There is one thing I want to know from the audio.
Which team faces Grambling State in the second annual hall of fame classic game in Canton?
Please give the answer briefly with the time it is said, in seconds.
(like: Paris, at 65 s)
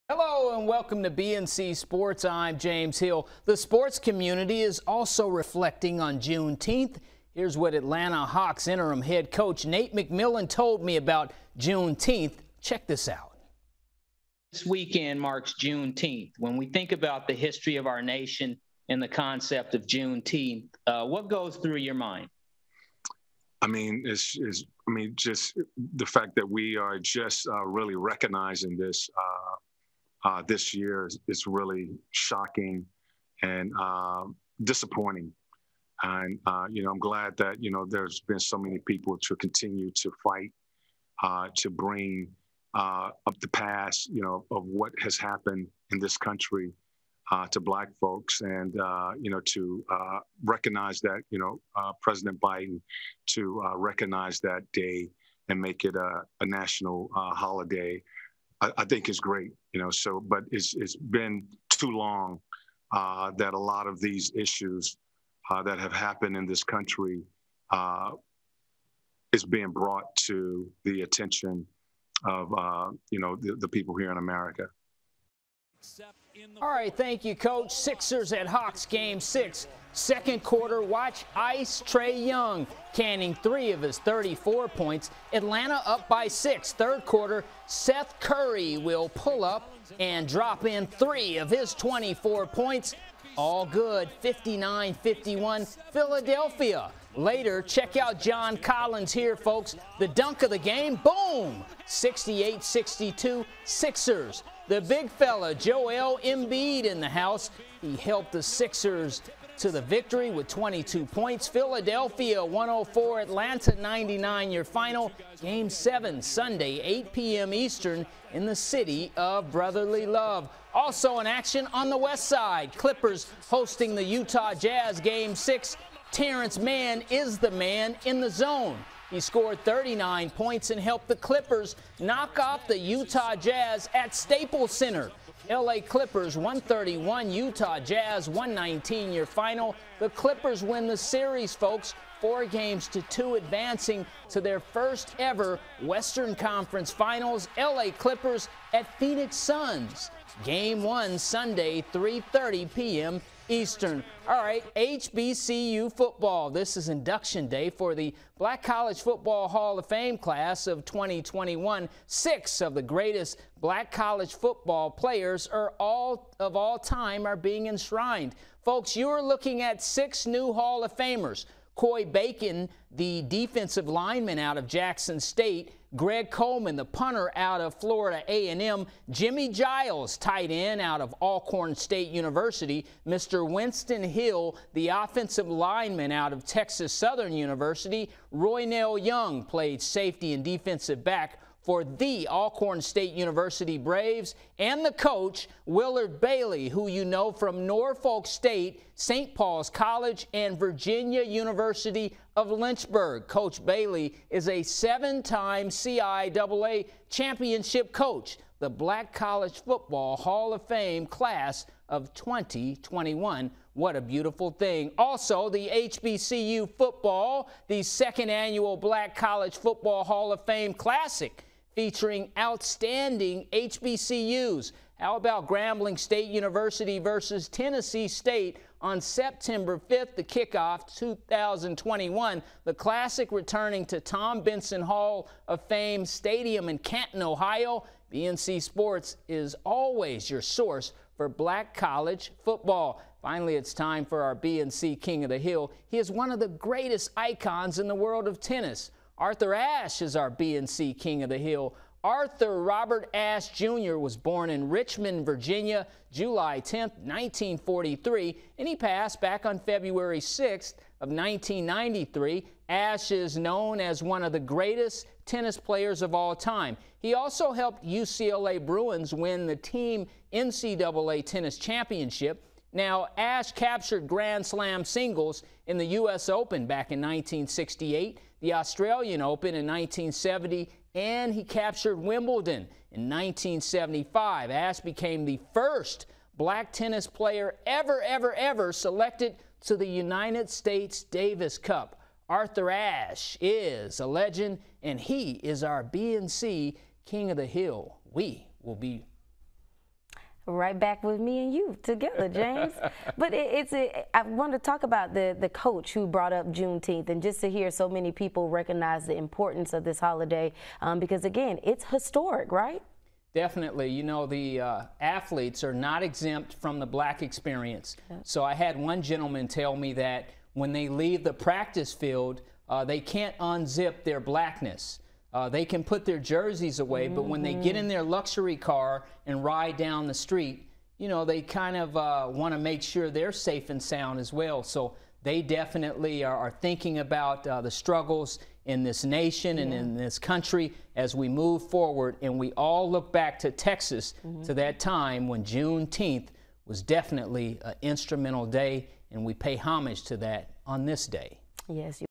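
Tennessee State, at 227 s.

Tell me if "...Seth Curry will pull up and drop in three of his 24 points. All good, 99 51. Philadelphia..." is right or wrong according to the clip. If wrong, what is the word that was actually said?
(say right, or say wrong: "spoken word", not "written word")
wrong: "59", not "99".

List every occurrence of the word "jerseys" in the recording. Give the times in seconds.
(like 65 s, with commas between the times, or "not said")
326 s.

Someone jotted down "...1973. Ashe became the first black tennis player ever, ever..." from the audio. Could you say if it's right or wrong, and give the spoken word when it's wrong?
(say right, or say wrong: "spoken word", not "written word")
wrong: "1975", not "1973".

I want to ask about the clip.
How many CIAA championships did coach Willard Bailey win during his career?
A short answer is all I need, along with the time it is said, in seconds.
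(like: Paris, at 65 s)
7, at 204 s.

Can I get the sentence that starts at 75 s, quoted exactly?
Except all right, thank you, Coach.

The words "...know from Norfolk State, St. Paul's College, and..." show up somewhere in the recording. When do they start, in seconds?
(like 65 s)
197 s.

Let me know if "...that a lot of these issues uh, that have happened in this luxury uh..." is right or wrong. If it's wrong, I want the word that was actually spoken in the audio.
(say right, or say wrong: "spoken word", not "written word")
wrong: "country", not "luxury".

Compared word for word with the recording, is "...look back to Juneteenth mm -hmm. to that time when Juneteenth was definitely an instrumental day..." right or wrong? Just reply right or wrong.
wrong.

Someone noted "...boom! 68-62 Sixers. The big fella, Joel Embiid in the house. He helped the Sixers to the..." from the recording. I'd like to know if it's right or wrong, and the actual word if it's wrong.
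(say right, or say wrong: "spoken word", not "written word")
right.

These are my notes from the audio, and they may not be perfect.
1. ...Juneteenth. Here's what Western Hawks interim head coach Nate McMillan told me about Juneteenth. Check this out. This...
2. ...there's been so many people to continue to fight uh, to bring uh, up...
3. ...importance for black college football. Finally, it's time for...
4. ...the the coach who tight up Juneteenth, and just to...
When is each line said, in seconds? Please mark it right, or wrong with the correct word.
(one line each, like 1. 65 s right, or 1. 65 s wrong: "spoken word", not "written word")
1. 6 s wrong: "Atlanta", not "Western"
2. 37 s right
3. 240 s wrong: "source", not "importance"
4. 305 s wrong: "brought", not "tight".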